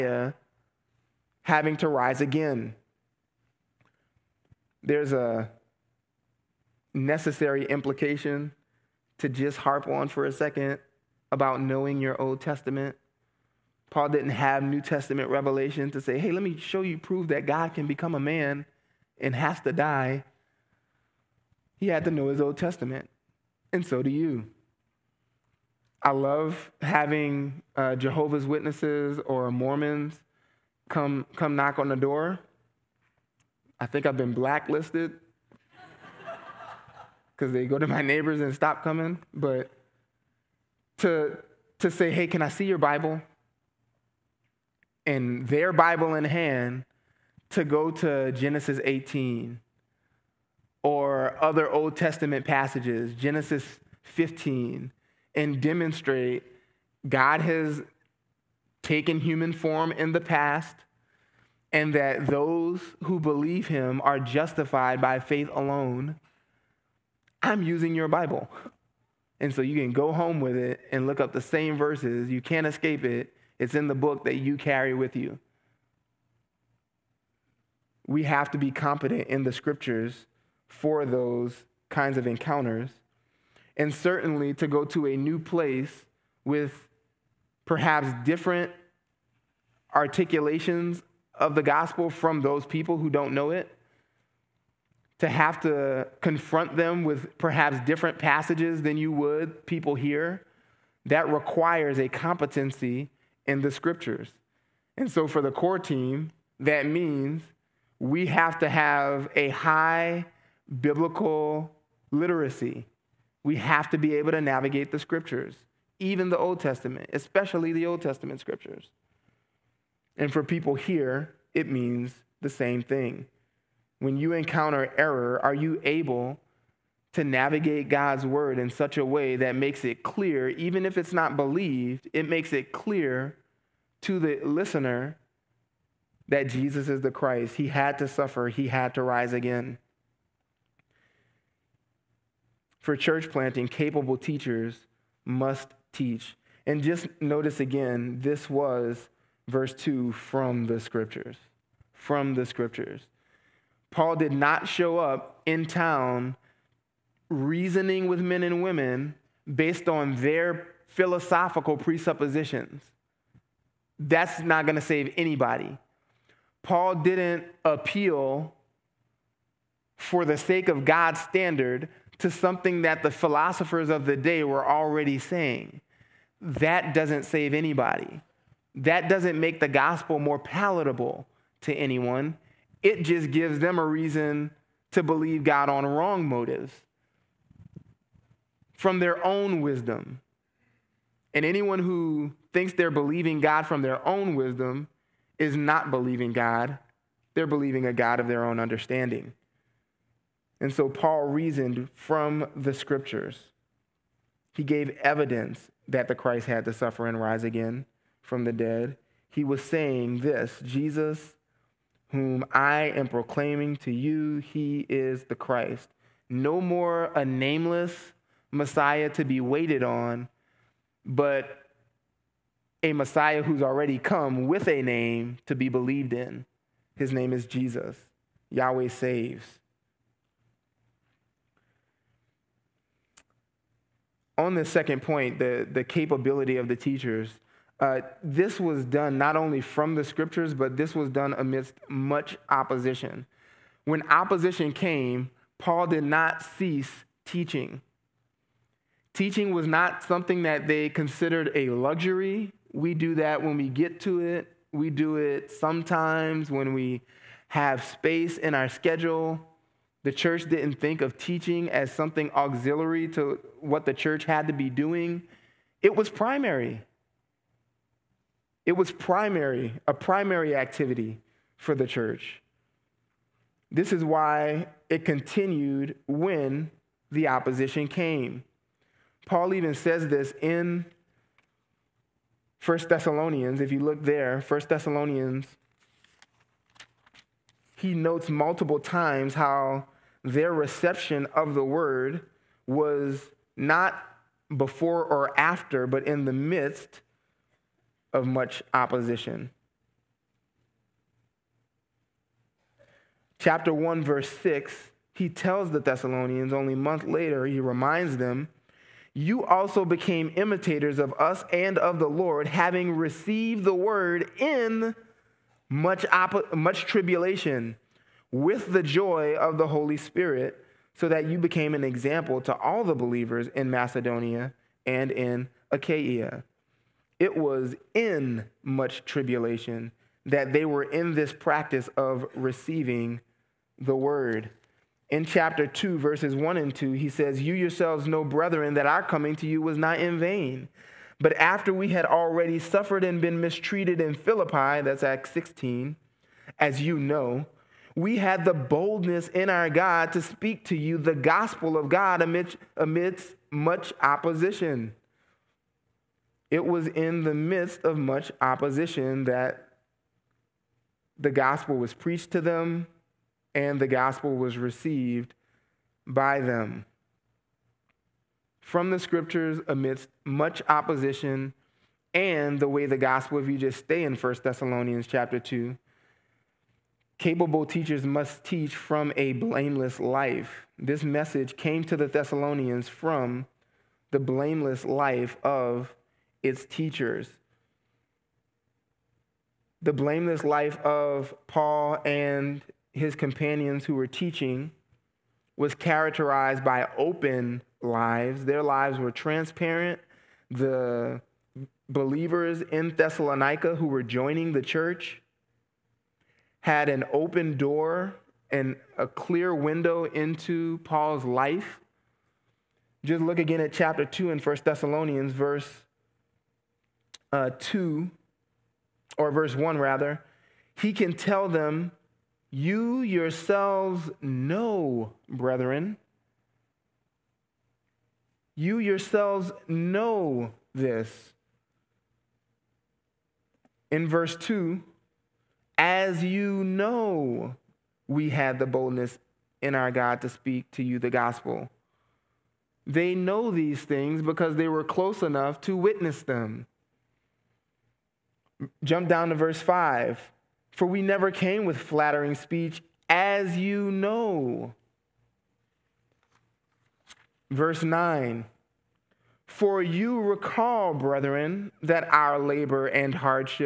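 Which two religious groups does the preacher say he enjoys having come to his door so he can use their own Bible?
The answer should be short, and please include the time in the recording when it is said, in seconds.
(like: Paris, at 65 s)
Jehovah's Witnesses or Mormons, at 27 s.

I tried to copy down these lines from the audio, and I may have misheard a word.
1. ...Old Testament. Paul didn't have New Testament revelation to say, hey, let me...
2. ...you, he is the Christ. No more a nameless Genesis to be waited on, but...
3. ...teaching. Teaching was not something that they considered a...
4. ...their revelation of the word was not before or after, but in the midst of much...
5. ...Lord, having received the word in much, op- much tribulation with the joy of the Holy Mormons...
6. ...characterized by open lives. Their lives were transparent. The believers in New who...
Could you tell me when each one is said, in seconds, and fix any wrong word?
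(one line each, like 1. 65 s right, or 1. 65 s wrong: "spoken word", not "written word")
1. 12 s right
2. 213 s wrong: "Messiah", not "Genesis"
3. 247 s right
4. 290 s wrong: "reception", not "revelation"
5. 312 s wrong: "Spirit", not "Mormons"
6. 395 s wrong: "Thessalonica", not "New".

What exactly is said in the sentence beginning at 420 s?
He can tell them, You yourselves know, brethren.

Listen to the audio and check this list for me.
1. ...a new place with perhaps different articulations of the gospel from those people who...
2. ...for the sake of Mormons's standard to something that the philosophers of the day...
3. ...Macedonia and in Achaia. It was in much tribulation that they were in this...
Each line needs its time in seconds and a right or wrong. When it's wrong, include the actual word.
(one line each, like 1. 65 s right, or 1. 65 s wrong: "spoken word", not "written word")
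1. 85 s right
2. 169 s wrong: "God", not "Mormons"
3. 323 s right.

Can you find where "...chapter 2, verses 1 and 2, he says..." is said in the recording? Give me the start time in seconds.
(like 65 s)
335 s.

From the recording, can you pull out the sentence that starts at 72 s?
You can't escape it, it's in the book that you carry with you.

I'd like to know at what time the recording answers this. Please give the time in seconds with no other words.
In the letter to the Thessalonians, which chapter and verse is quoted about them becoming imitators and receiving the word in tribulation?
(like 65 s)
303 s.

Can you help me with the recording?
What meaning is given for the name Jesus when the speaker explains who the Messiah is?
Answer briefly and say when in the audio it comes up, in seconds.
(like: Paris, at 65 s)
Yahweh saves, at 228 s.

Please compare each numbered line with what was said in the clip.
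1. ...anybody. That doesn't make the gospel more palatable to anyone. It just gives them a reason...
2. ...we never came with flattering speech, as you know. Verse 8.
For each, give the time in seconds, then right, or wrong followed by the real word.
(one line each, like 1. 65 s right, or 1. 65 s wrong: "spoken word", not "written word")
1. 177 s right
2. 450 s wrong: "9", not "8".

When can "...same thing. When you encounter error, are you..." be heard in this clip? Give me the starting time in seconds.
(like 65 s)
122 s.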